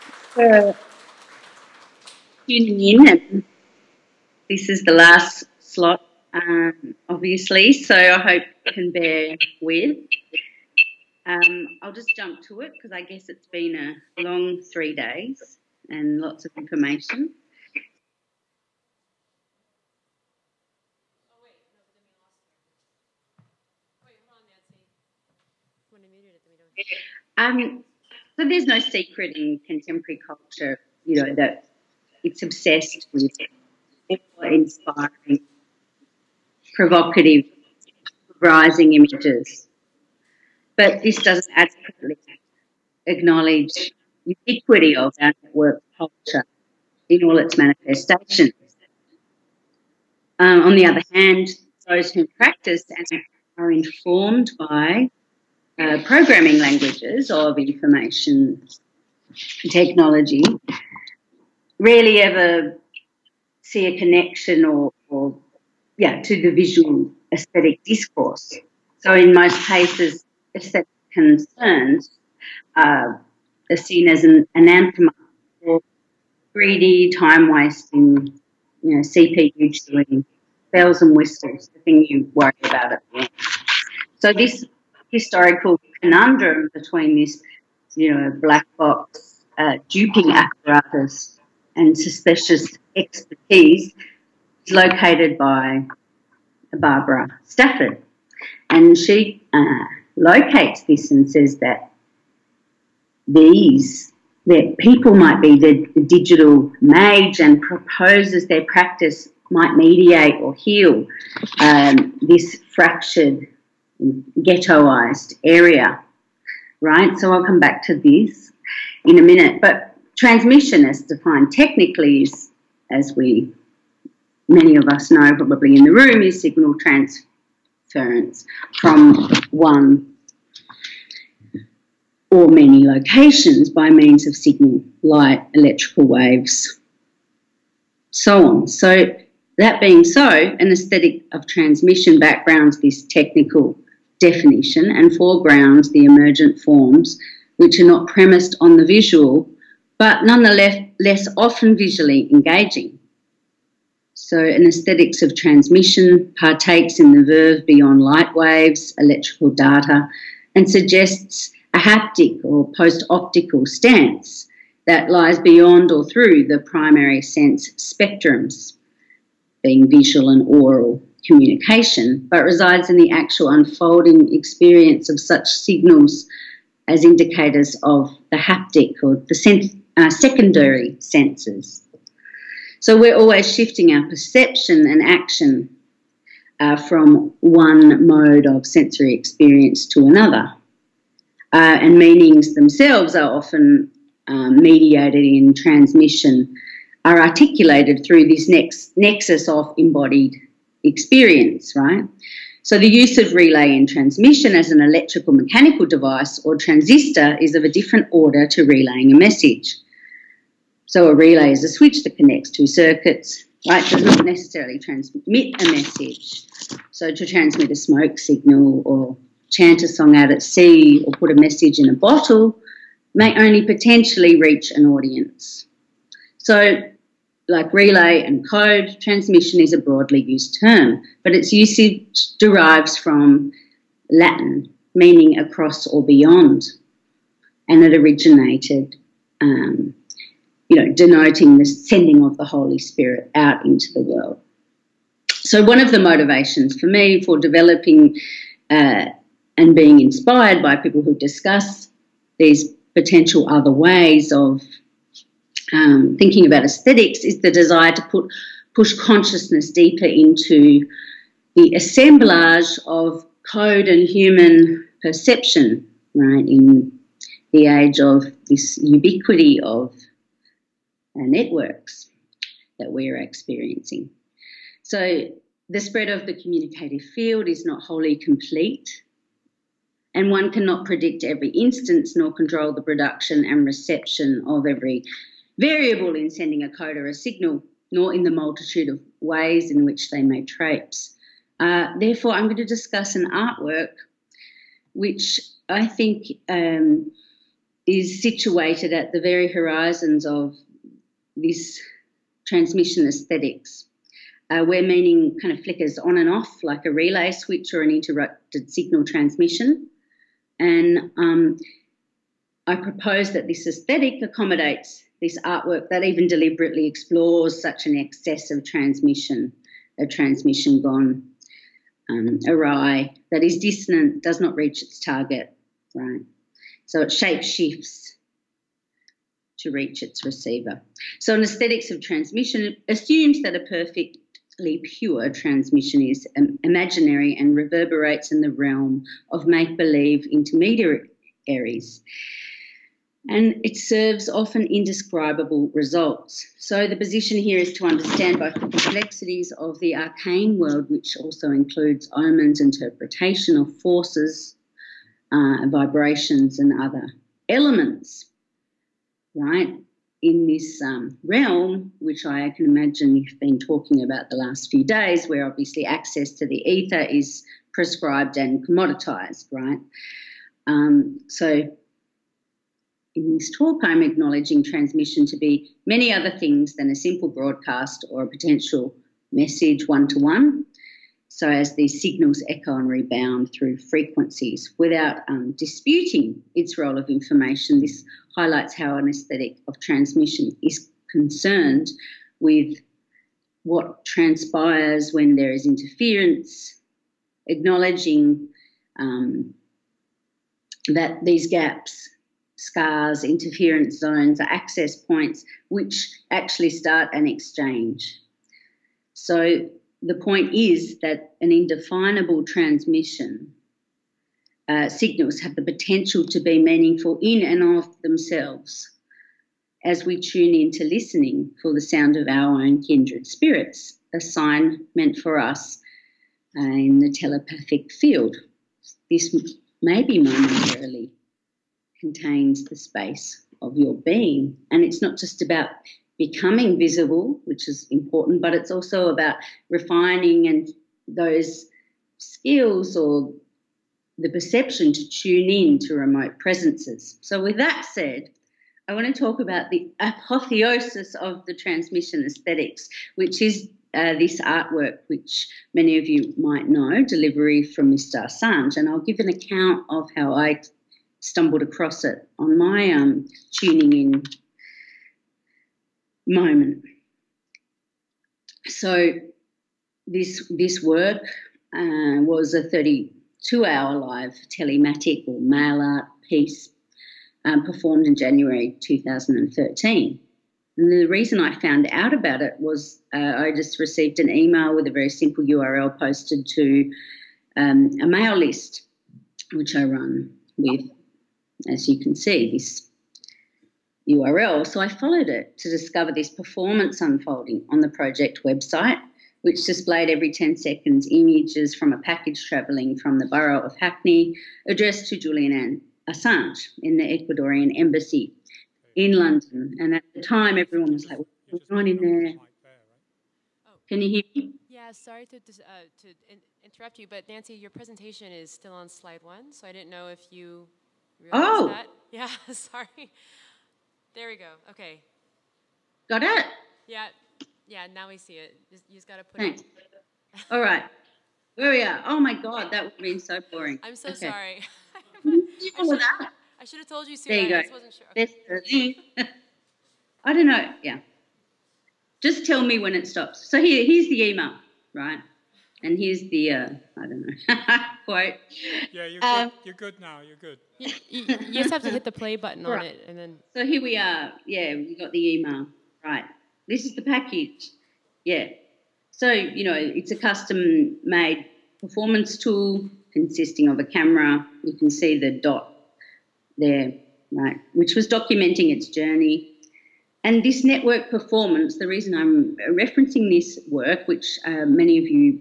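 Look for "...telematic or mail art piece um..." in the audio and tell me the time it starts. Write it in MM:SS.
07:54.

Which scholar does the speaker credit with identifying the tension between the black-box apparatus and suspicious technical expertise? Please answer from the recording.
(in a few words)
Barbara Stafford.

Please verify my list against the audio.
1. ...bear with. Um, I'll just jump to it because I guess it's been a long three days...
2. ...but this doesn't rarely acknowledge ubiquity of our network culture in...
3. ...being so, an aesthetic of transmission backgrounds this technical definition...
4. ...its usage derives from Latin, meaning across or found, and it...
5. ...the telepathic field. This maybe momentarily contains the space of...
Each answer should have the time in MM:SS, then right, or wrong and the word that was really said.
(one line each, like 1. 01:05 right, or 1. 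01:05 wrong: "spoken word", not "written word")
1. 00:08 right
2. 00:40 wrong: "adequately", not "rarely"
3. 02:19 right
4. 03:51 wrong: "beyond", not "found"
5. 07:07 right.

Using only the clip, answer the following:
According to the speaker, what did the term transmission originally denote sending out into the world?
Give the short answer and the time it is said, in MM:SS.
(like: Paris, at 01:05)
the Holy Spirit, at 04:02.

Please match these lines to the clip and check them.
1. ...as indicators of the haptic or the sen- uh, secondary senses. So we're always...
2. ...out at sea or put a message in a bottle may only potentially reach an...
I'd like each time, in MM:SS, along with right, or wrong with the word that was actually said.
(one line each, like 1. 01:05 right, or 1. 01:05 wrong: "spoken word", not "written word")
1. 02:56 right
2. 03:40 right.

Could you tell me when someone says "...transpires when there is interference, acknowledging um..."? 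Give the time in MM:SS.
06:34.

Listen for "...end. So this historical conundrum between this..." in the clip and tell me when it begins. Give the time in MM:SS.
01:23.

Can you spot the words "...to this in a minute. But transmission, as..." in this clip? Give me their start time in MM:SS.
01:57.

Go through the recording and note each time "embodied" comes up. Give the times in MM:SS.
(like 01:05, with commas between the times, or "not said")
03:19.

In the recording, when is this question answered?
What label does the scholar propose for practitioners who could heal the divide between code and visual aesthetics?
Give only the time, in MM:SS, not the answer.
01:46.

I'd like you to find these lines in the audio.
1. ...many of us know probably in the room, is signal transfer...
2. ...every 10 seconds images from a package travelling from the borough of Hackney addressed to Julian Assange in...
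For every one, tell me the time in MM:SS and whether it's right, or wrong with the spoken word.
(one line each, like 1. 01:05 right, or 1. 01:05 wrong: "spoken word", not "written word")
1. 02:04 right
2. 08:20 right.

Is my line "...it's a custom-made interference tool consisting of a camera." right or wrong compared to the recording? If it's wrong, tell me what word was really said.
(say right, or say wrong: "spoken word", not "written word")
wrong: "performance", not "interference".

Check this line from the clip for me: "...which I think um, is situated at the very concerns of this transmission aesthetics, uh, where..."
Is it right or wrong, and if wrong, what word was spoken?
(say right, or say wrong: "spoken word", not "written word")
wrong: "horizons", not "concerns".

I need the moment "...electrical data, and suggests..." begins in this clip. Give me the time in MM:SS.
02:38.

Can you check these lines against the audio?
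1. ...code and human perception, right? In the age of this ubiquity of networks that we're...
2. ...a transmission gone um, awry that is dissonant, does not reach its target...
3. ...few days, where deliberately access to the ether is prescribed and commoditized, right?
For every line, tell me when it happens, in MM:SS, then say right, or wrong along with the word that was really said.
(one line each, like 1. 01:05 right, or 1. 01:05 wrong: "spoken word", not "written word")
1. 04:23 right
2. 05:19 right
3. 06:04 wrong: "obviously", not "deliberately".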